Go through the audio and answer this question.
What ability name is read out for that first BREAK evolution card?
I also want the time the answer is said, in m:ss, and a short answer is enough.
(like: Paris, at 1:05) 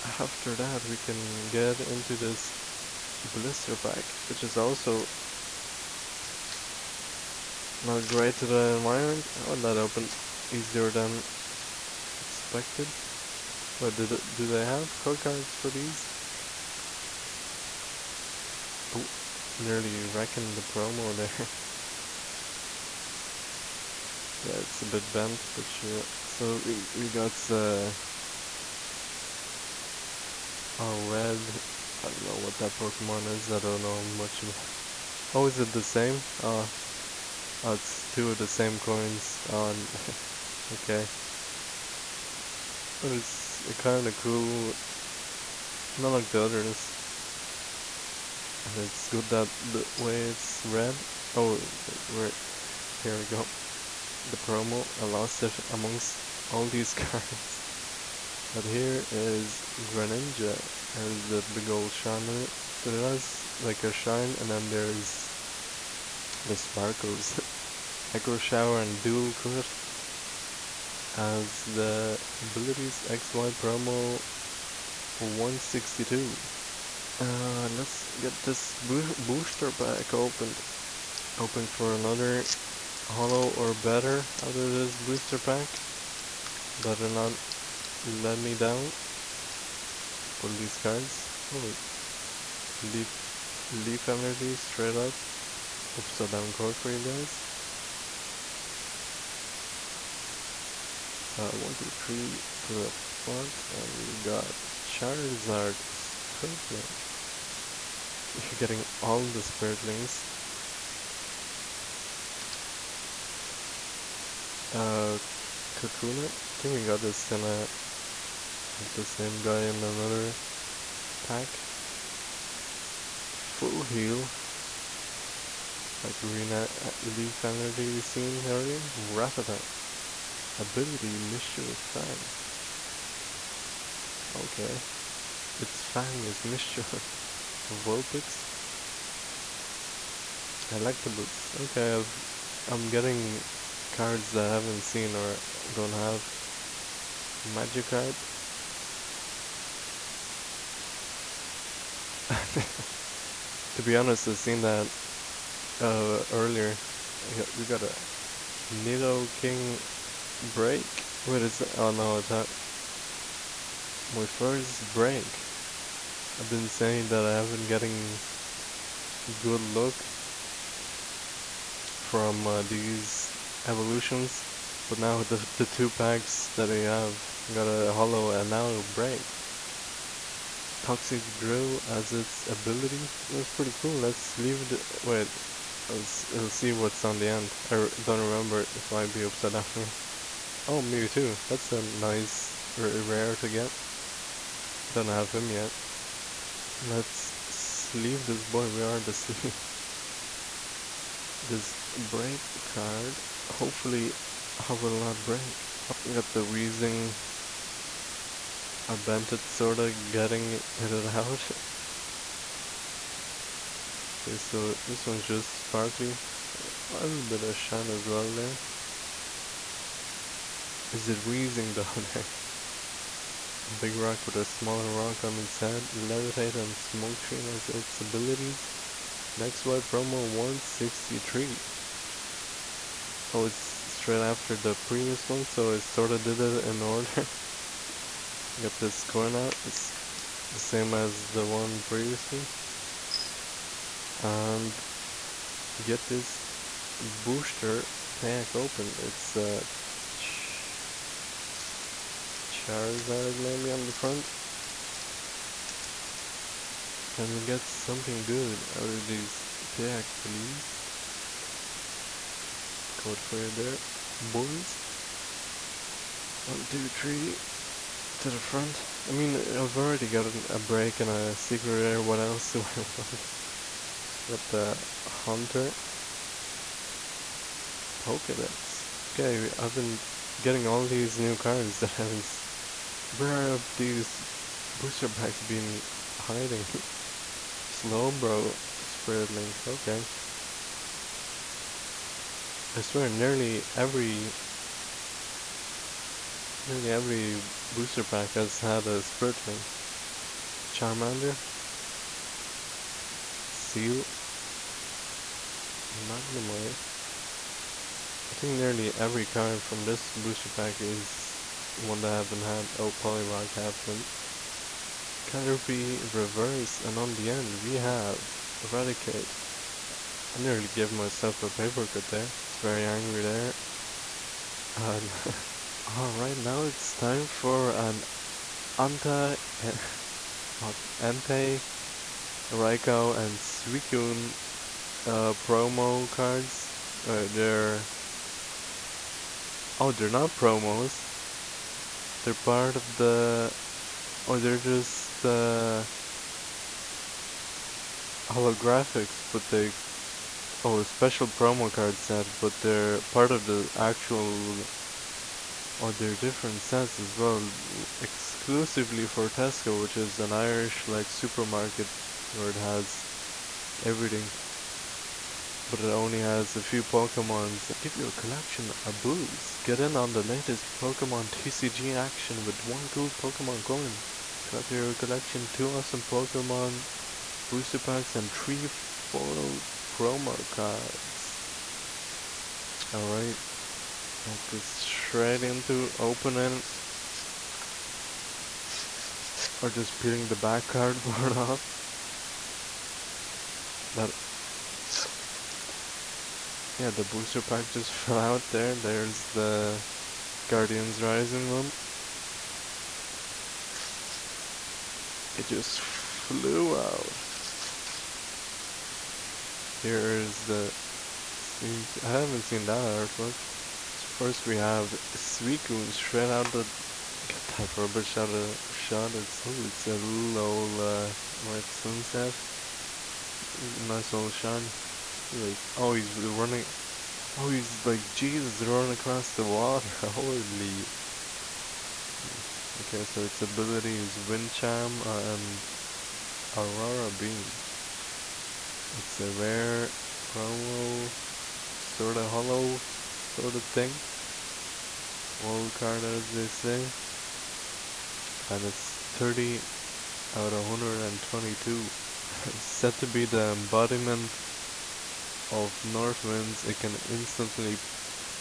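Toxic Drill, at 3:00.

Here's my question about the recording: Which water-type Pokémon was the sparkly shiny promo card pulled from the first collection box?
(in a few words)
Greninja.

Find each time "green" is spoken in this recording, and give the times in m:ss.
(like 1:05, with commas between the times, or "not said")
2:06.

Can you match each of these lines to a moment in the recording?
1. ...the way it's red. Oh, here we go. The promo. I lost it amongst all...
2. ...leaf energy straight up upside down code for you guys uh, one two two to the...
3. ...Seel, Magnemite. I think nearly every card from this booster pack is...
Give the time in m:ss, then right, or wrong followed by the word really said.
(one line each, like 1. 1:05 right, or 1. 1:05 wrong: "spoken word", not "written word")
1. 0:49 right
2. 1:33 wrong: "three", not "two"
3. 5:03 right.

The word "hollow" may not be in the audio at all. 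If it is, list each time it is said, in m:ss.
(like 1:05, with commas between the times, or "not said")
1:23, 2:57, 7:22.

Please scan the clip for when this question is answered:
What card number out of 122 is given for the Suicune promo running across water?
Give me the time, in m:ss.
7:29.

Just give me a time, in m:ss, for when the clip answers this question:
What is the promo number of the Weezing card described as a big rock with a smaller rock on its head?
3:50.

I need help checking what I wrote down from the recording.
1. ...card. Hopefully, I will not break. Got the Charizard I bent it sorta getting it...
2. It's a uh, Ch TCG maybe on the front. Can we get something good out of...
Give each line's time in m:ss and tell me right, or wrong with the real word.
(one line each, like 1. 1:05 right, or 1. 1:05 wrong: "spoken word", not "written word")
1. 3:22 wrong: "Weezing", not "Charizard"
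2. 4:09 wrong: "Charizard", not "TCG".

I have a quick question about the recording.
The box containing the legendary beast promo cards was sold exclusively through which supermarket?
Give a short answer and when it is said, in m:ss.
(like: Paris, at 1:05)
Tesco, at 5:59.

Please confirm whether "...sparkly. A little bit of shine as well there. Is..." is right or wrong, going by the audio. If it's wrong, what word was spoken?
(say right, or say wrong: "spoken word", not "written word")
right.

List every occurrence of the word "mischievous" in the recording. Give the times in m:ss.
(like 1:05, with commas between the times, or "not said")
2:11, 2:16.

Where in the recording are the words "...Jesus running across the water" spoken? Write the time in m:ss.
7:08.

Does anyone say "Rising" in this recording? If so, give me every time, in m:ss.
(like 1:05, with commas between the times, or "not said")
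6:41.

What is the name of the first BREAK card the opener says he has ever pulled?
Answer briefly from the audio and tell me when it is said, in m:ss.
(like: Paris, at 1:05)
Nidoking BREAK, at 2:38.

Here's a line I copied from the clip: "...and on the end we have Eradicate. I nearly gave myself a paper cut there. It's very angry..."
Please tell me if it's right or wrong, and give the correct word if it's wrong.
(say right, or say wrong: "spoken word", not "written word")
right.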